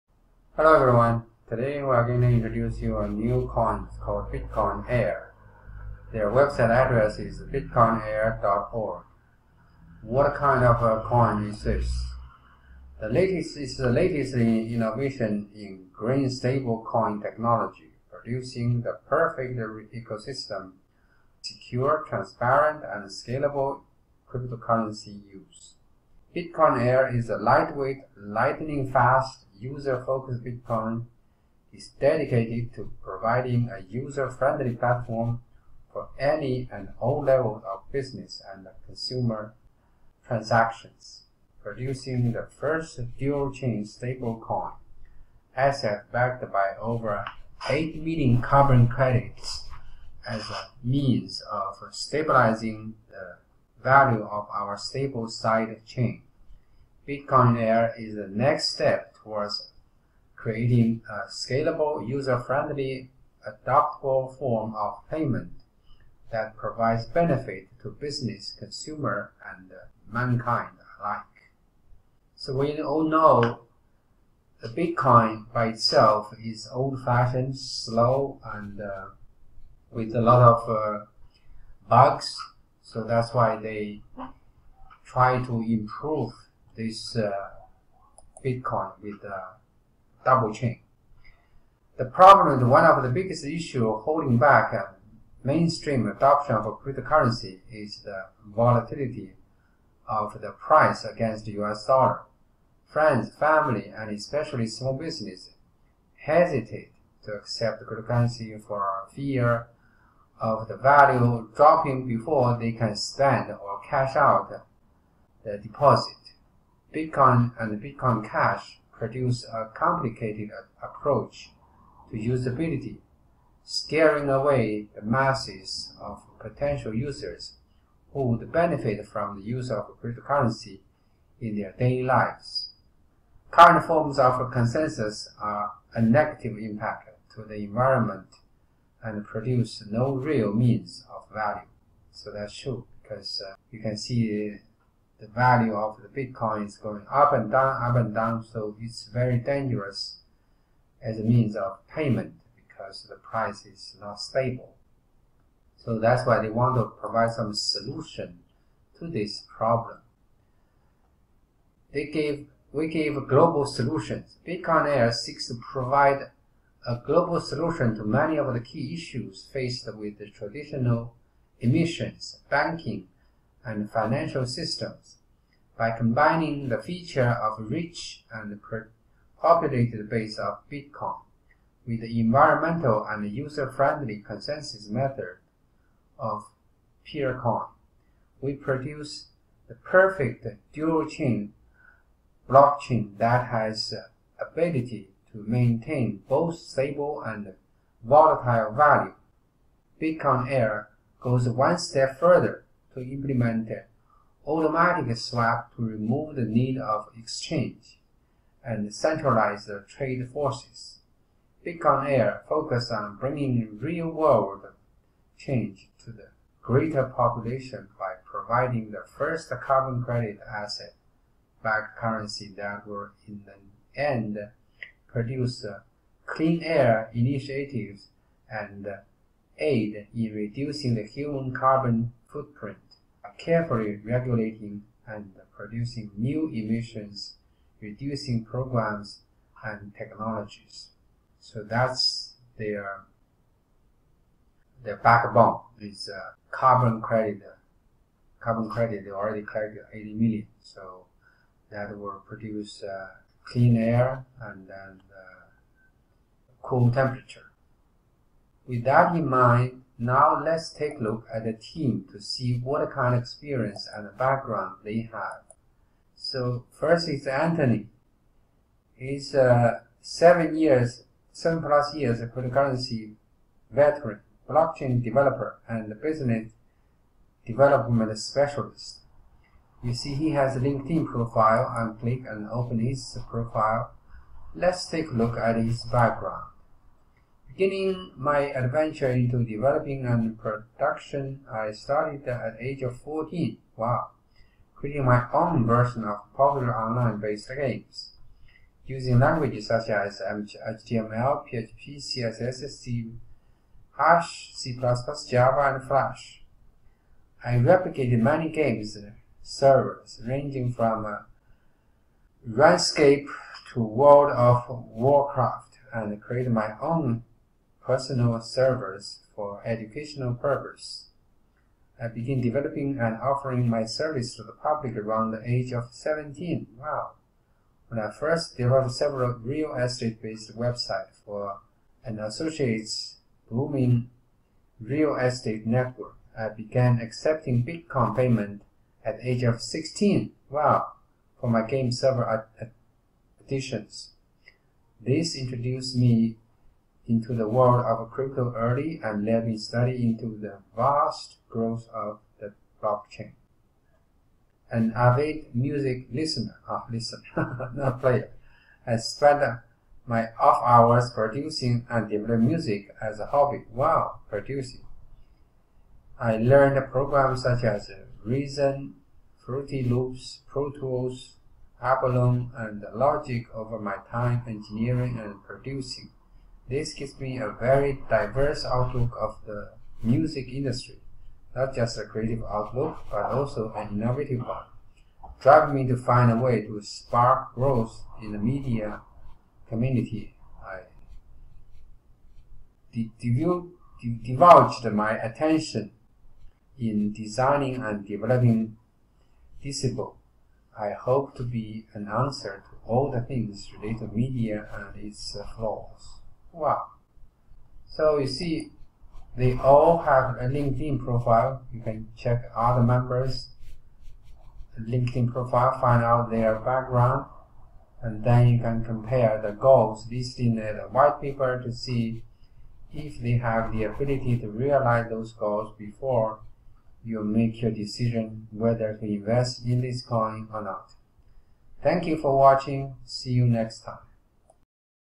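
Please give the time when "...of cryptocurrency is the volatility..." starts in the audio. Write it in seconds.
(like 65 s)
96 s.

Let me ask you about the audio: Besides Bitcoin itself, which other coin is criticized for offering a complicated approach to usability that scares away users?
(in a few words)
Bitcoin Cash.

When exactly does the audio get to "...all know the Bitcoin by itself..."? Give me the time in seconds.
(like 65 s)
72 s.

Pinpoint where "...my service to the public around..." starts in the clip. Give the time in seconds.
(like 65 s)
323 s.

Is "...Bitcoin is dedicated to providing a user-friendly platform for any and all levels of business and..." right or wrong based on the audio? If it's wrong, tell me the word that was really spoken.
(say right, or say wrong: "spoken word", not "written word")
right.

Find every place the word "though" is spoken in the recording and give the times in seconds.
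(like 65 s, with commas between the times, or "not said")
not said.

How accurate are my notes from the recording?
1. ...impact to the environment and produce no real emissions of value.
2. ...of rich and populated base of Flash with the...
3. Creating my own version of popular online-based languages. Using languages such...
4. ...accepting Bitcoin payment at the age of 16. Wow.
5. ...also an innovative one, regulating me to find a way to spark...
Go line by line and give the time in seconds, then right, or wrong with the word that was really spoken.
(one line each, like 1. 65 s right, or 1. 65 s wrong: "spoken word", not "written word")
1. 136 s wrong: "means", not "emissions"
2. 177 s wrong: "Bitcoin", not "Flash"
3. 294 s wrong: "games", not "languages"
4. 337 s right
5. 383 s wrong: "driving", not "regulating".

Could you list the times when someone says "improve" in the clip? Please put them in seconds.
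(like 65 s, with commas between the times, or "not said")
85 s.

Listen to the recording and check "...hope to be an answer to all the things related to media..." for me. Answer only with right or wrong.
right.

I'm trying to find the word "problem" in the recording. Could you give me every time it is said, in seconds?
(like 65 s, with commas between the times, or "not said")
92 s, 159 s.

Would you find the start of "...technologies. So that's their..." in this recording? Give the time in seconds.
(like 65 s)
239 s.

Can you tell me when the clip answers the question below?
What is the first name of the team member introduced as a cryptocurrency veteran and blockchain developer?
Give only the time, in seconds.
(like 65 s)
267 s.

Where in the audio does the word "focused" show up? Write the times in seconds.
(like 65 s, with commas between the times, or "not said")
29 s, 212 s.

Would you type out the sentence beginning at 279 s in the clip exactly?
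You see he has a LinkedIn profile and click and open his profile.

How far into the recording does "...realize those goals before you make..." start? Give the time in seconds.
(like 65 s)
424 s.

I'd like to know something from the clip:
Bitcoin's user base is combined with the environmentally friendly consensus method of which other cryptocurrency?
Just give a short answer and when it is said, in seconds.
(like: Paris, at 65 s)
Peercoin, at 187 s.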